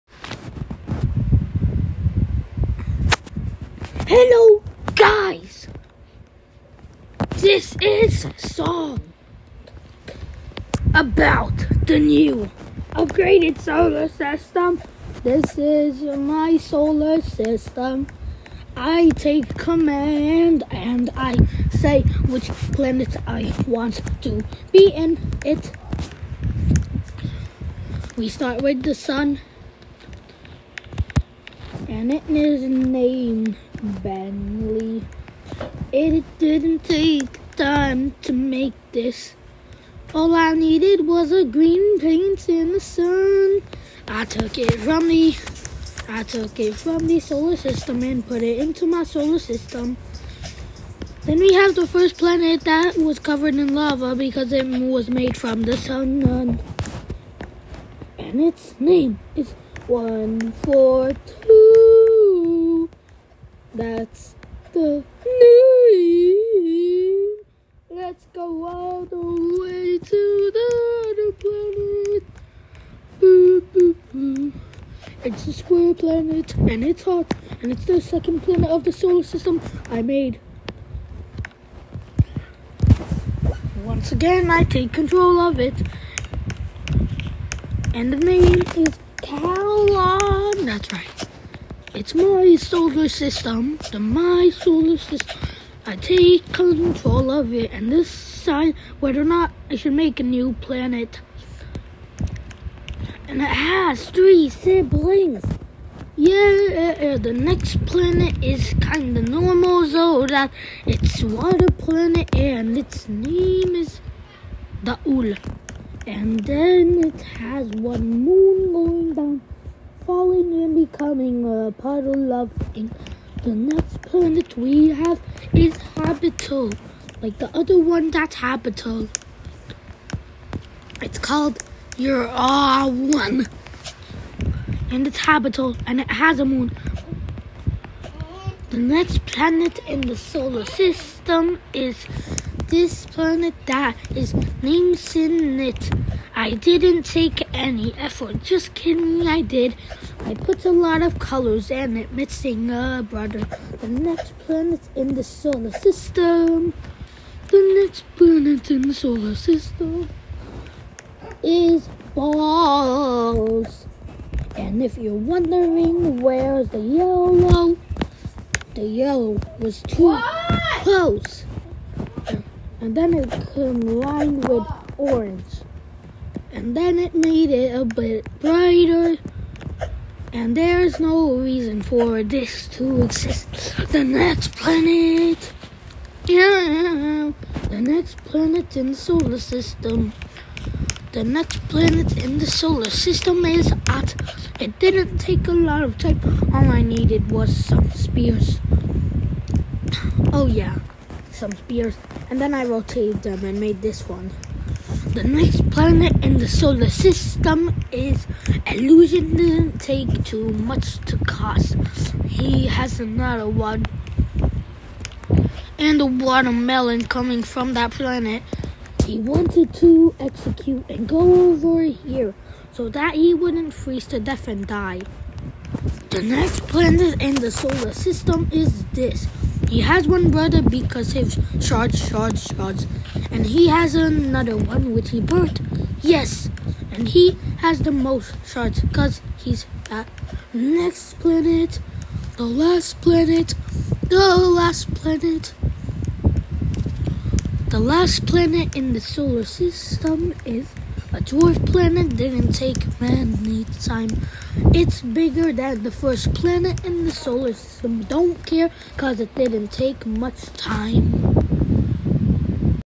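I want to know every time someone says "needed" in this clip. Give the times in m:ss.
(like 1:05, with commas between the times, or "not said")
0:40, 3:16.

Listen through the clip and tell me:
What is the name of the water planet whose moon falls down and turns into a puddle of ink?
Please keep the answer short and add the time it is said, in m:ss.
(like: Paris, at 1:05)
Daul, at 1:54.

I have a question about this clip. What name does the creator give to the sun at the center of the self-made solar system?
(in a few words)
Bentley.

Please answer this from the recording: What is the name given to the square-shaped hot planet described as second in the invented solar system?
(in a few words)
Caroline.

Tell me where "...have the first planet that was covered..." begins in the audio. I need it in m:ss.
0:51.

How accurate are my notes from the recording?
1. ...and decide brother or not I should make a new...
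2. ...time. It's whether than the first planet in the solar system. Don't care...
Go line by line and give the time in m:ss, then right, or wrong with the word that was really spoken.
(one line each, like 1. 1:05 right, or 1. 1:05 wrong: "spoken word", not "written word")
1. 1:37 wrong: "whether", not "brother"
2. 4:13 wrong: "bigger", not "whether".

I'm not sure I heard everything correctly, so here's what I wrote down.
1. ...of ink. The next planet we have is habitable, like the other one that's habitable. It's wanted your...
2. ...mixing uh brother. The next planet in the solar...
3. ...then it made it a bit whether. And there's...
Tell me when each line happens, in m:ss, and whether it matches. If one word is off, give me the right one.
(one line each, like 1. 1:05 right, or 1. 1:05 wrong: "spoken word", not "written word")
1. 2:02 wrong: "called", not "wanted"
2. 2:32 right
3. 2:56 wrong: "brighter", not "whether".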